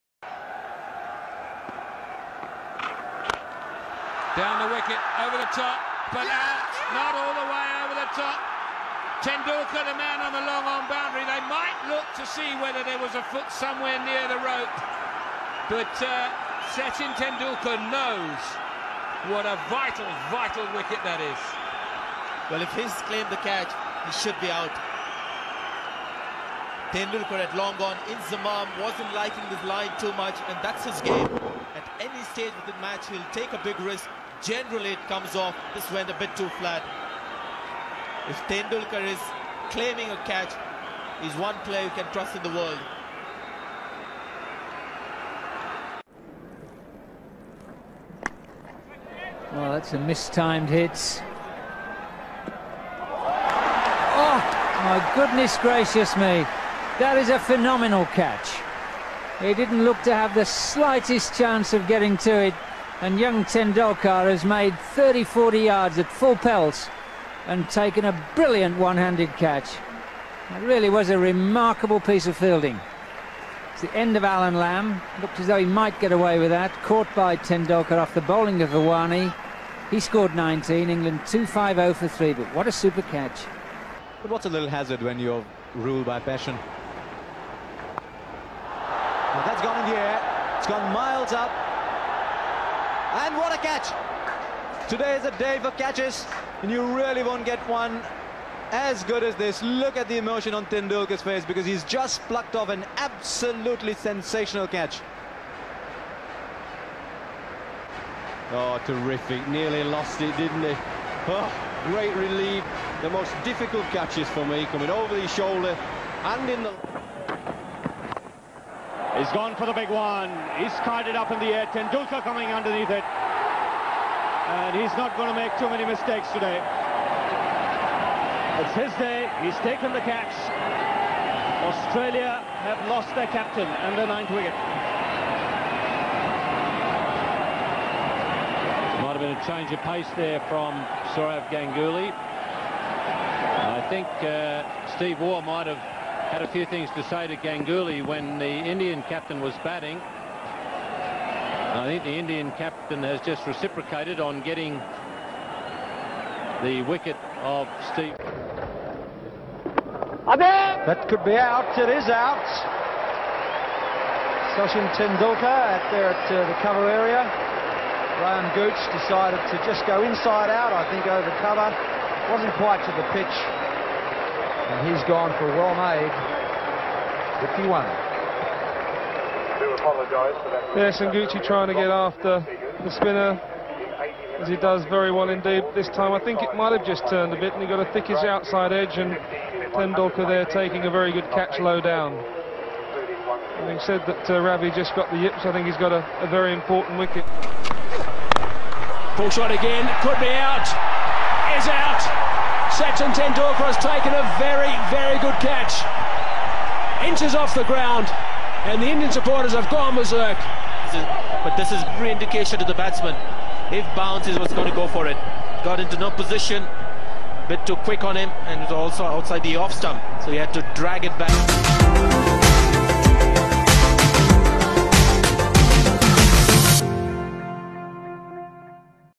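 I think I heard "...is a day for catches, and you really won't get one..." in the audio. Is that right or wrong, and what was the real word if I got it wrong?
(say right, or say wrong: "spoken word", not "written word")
right.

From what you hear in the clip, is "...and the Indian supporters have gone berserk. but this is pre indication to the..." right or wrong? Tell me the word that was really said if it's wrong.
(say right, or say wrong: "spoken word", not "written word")
right.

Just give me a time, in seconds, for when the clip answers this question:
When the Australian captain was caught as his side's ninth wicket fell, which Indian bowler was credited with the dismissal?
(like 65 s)
141 s.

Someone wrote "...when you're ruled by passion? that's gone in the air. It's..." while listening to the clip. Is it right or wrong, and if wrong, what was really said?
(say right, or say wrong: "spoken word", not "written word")
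right.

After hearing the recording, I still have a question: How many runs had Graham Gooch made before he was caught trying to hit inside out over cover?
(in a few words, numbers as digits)
51.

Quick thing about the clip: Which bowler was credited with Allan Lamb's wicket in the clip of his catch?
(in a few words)
Hirwani.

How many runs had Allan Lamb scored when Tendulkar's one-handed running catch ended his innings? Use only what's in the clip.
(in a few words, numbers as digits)
19.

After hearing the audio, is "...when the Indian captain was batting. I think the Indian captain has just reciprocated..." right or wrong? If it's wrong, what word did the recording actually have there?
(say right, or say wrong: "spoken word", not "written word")
right.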